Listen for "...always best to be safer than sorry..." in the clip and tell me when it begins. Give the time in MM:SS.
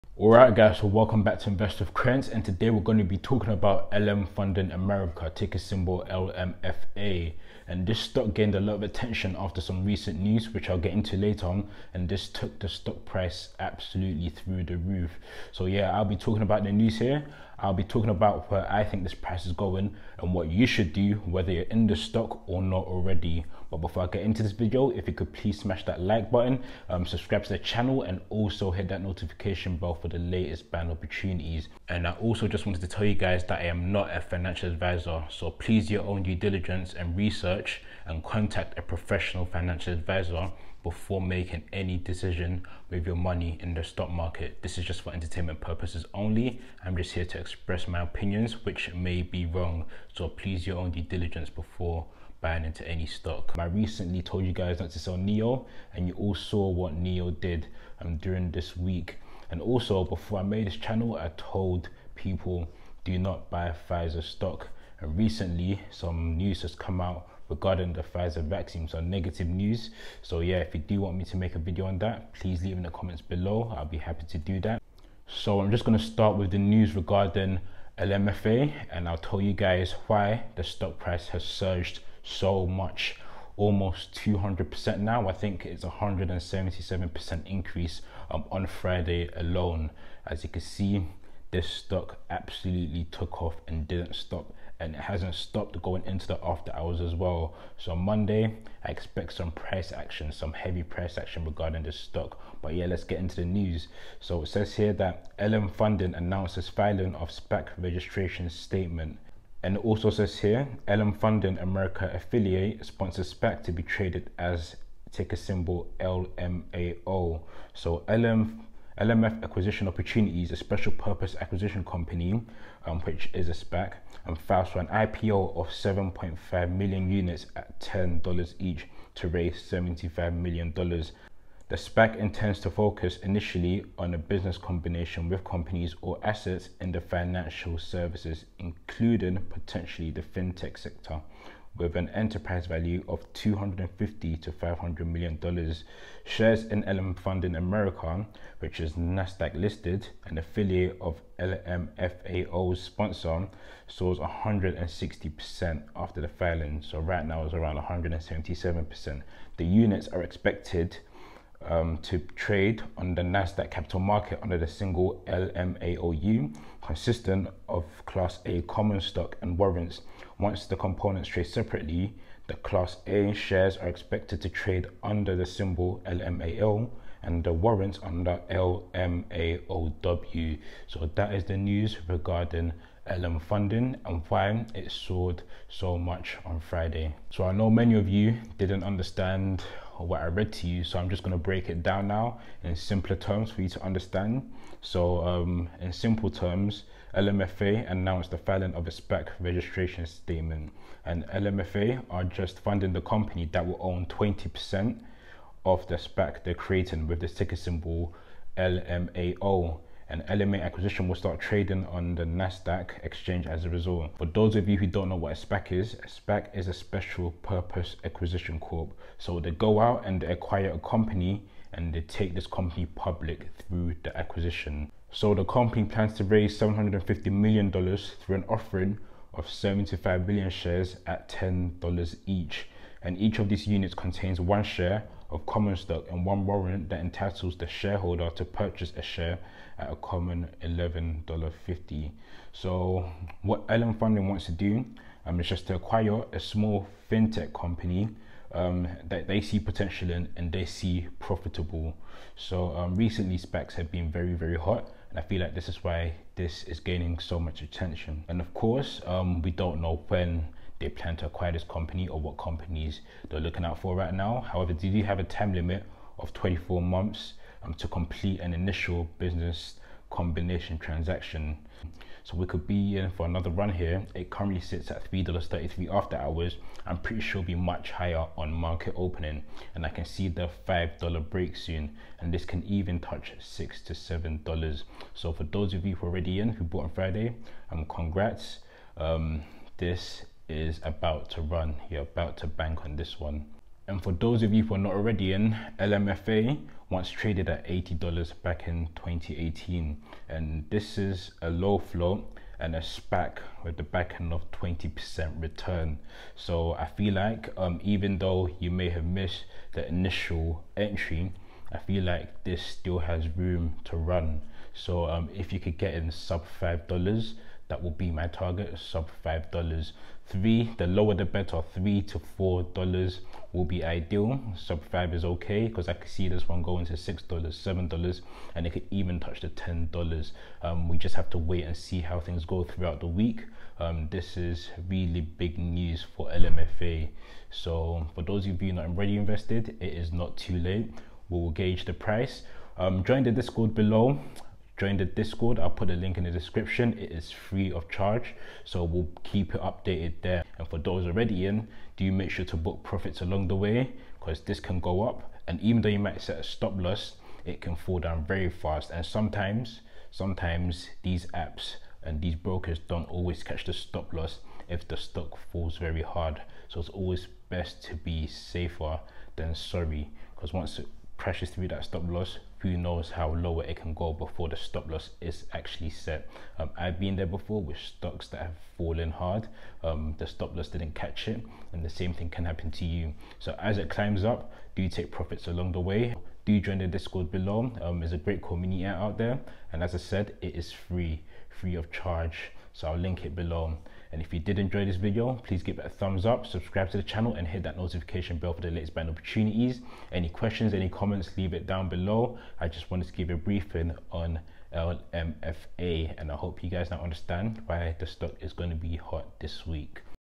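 06:06.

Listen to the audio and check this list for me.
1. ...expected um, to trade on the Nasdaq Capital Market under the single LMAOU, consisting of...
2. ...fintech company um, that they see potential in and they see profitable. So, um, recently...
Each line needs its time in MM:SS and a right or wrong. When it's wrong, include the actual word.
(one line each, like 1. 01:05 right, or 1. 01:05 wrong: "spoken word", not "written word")
1. 02:40 right
2. 04:07 right.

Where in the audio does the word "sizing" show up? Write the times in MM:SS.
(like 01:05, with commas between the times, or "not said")
not said.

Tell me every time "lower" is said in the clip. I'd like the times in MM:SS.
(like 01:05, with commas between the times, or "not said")
05:20, 06:13.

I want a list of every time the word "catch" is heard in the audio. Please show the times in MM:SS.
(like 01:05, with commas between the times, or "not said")
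06:03, 06:20.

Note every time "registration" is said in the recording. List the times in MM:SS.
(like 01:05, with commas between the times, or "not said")
01:47, 03:19.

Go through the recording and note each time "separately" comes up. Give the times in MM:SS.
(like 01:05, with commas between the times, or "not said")
02:51.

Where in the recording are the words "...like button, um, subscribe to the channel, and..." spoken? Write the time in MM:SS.
00:26.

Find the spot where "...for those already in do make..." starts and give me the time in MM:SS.
05:50.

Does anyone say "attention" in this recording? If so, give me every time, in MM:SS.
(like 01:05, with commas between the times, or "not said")
00:08, 04:17.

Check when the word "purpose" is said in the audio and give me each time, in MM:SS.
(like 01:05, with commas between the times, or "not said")
00:45, 02:00, 03:37.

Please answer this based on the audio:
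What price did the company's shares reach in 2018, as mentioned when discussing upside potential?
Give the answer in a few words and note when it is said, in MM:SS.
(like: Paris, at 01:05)
$80, at 04:57.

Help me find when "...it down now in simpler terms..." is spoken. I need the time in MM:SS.
03:11.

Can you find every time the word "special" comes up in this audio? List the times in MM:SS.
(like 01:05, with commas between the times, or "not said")
02:00, 03:36.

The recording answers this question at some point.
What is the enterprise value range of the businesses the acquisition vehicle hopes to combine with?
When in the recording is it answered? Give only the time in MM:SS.
02:23.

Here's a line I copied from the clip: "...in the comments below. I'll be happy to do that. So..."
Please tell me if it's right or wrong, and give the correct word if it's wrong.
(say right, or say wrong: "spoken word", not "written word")
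right.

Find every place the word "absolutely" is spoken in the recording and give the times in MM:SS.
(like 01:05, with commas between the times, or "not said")
00:13, 01:32.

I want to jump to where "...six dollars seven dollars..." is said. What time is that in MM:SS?
05:26.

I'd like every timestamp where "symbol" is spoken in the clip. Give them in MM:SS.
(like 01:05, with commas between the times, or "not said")
00:05, 01:55, 02:55, 03:27.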